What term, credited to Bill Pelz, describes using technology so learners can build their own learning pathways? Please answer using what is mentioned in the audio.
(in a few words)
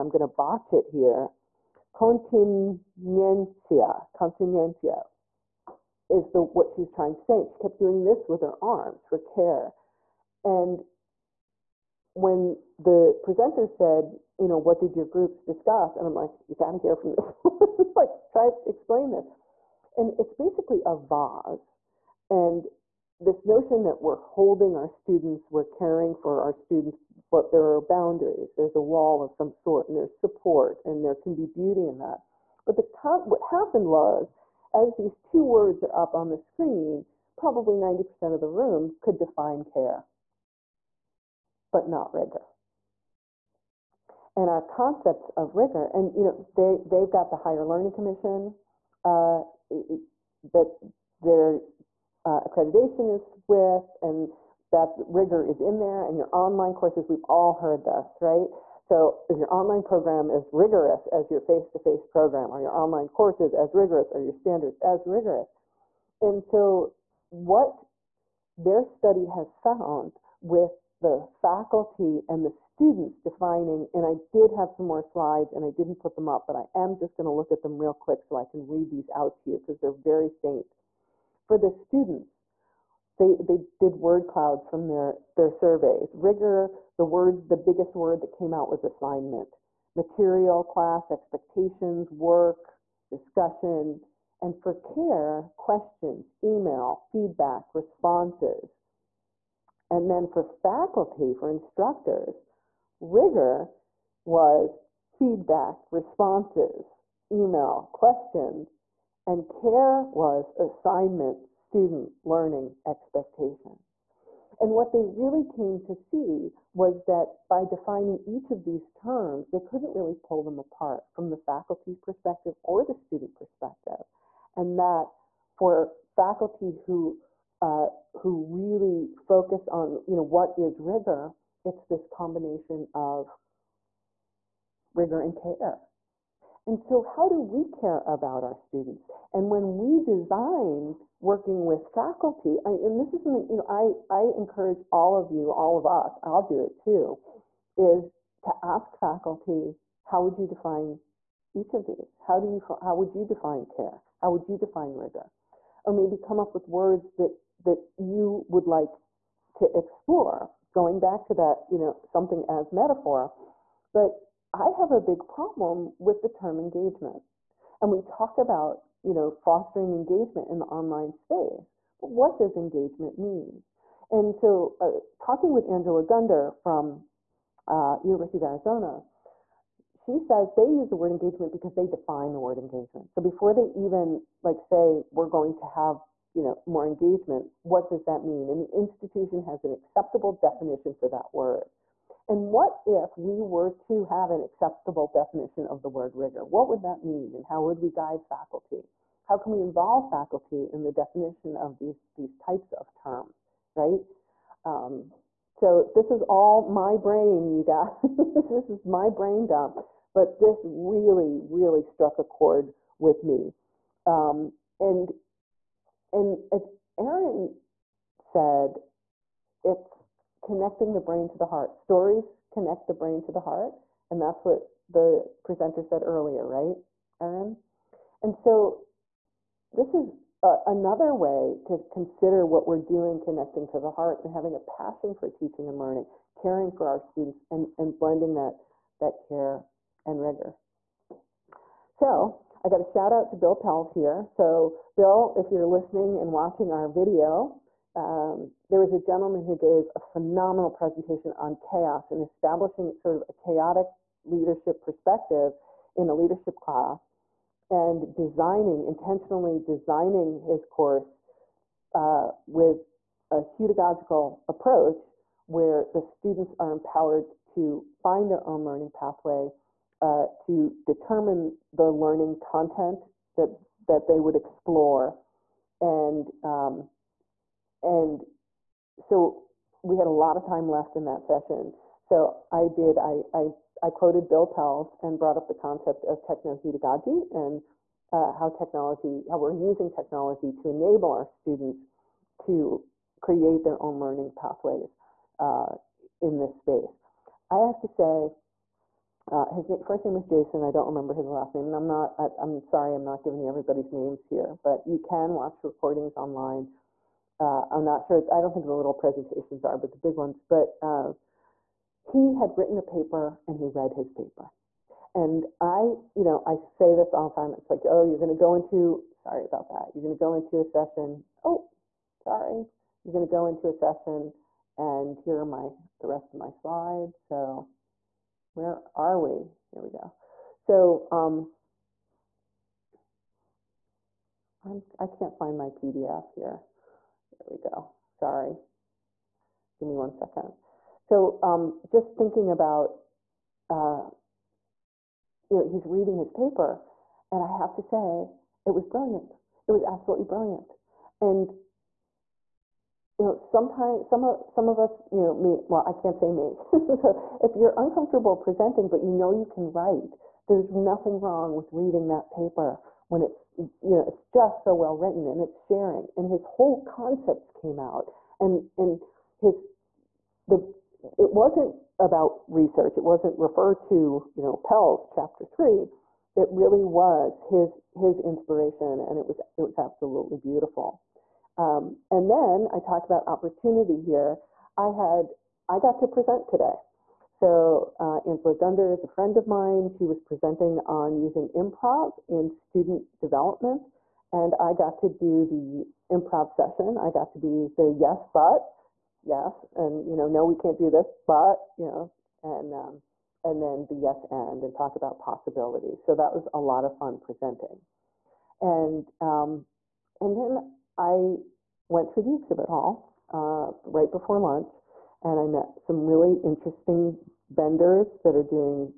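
technoheutagogy.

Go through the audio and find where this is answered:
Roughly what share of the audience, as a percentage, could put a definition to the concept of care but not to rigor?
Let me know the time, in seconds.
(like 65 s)
37 s.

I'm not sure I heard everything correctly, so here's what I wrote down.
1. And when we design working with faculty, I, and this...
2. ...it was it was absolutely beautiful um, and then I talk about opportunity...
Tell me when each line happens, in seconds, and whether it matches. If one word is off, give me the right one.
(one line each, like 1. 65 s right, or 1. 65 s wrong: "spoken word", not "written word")
1. 139 s right
2. 379 s right.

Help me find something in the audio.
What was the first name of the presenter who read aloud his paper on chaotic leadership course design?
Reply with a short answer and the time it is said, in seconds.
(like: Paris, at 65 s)
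Jason, at 300 s.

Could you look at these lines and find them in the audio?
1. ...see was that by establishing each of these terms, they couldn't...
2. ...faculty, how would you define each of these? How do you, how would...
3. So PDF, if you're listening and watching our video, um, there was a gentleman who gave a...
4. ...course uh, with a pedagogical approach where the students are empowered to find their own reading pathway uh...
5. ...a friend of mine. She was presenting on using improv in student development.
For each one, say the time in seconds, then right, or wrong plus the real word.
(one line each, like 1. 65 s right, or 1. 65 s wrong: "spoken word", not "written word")
1. 115 s wrong: "defining", not "establishing"
2. 148 s right
3. 244 s wrong: "Bill", not "PDF"
4. 260 s wrong: "learning", not "reading"
5. 389 s right.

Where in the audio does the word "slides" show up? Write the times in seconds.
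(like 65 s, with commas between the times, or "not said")
75 s, 326 s.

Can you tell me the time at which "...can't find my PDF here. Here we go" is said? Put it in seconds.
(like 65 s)
335 s.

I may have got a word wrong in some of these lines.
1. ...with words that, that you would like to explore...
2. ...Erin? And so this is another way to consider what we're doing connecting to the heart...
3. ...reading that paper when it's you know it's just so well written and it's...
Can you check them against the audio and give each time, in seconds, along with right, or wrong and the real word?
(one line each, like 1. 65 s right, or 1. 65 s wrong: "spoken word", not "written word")
1. 156 s right
2. 227 s right
3. 361 s right.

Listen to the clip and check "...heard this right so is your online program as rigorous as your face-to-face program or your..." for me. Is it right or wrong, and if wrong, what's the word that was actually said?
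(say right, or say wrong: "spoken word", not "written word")
right.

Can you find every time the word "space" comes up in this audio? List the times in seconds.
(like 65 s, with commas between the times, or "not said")
171 s, 296 s.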